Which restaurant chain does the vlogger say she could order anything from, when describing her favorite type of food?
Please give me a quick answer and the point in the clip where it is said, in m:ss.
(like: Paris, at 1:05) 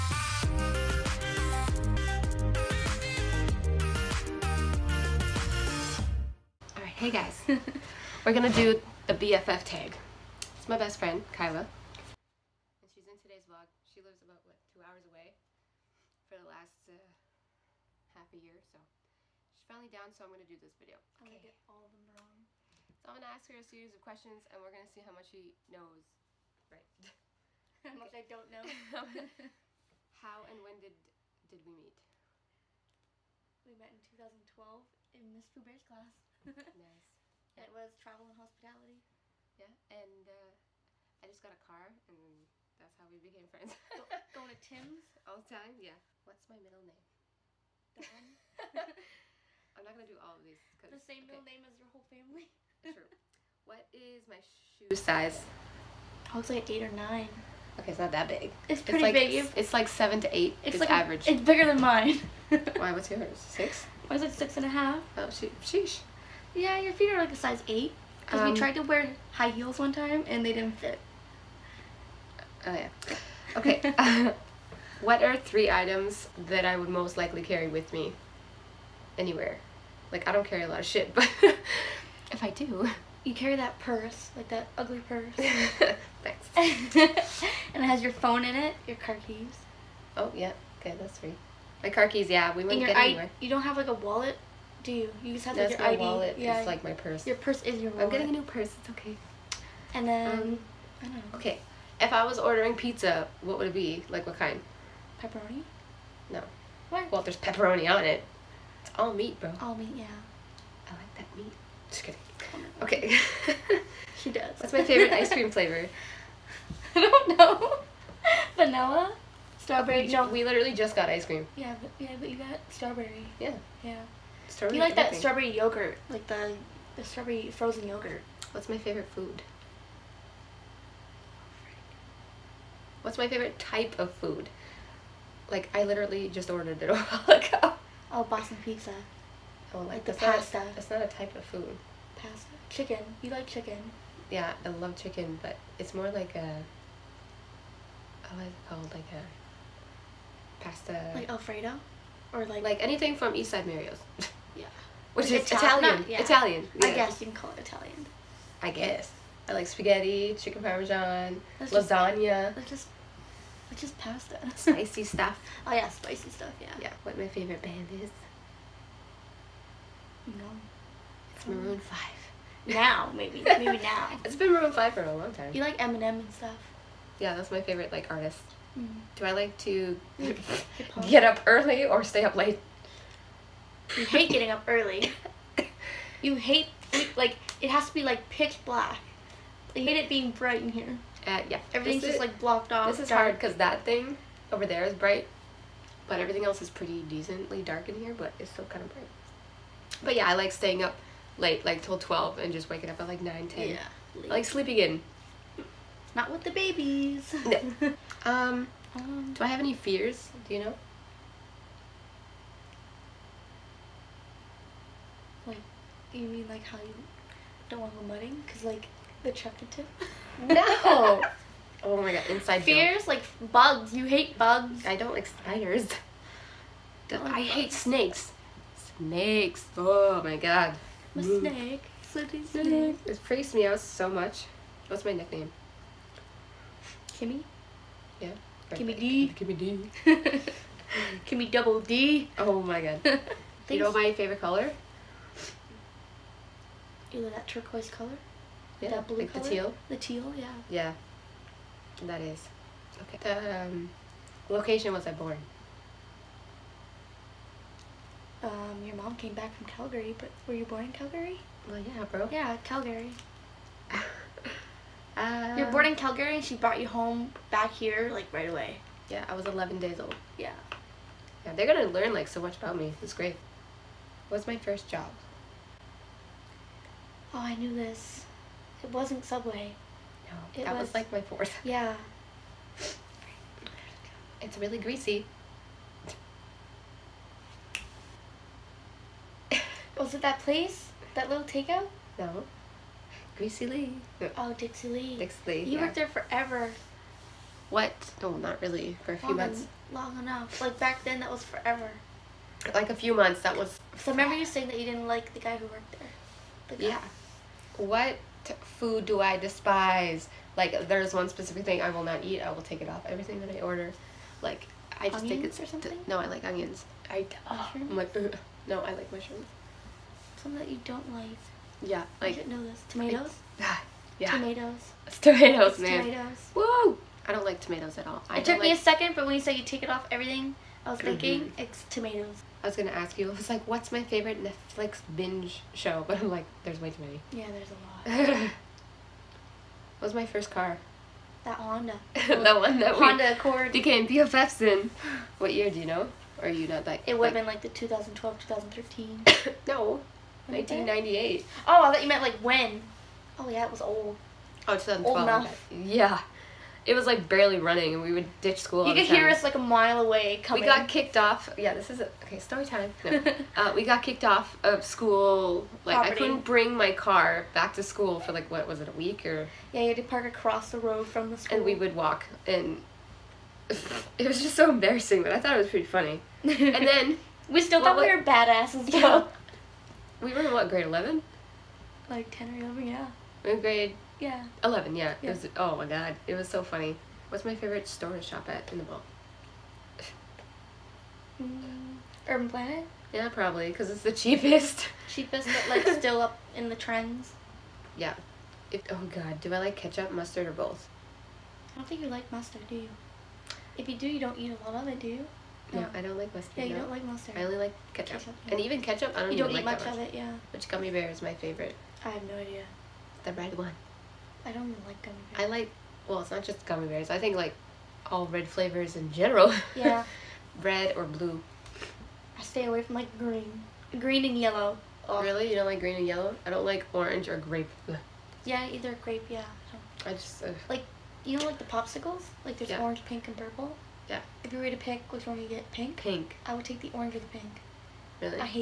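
East Side Mario's, at 2:33.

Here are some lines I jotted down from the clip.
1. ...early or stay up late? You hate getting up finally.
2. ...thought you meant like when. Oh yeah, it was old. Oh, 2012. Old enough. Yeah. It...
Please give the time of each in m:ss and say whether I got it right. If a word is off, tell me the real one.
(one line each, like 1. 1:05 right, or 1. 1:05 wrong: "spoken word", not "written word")
1. 3:01 wrong: "early", not "finally"
2. 5:51 right.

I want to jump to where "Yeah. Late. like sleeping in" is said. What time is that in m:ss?
3:23.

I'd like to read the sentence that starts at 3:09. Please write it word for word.
You hate it being bright in here.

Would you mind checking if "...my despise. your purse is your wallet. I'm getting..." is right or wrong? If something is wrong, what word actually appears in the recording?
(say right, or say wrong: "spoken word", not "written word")
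wrong: "purse", not "despise".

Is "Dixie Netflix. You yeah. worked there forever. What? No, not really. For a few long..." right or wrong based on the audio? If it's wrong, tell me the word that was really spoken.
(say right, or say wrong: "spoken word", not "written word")
wrong: "Lee", not "Netflix".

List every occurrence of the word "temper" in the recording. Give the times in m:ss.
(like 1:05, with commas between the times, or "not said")
not said.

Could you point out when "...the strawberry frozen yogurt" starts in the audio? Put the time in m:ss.
2:06.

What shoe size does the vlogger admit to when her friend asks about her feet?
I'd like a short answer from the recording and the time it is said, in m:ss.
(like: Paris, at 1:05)
6 and a half, at 1:04.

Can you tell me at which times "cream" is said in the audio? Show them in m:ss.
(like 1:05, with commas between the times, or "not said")
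1:55, 2:01.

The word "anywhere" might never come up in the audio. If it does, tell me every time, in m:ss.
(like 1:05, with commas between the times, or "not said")
1:19, 1:33.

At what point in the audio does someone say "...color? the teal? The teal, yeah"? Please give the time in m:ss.
4:09.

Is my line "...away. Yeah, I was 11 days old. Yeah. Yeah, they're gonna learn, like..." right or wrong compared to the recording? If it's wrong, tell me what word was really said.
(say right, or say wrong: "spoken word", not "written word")
right.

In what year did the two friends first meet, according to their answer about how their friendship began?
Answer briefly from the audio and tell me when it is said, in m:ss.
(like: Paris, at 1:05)
2012, at 0:33.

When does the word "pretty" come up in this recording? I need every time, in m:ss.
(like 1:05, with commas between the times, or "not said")
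0:58, 3:16, 6:15.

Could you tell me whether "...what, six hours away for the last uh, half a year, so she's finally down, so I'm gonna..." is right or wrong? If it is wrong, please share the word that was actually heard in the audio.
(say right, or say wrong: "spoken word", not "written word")
wrong: "two", not "six".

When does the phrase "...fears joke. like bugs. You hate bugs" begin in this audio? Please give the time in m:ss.
3:42.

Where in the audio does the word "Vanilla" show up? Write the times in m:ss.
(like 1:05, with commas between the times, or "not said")
1:58.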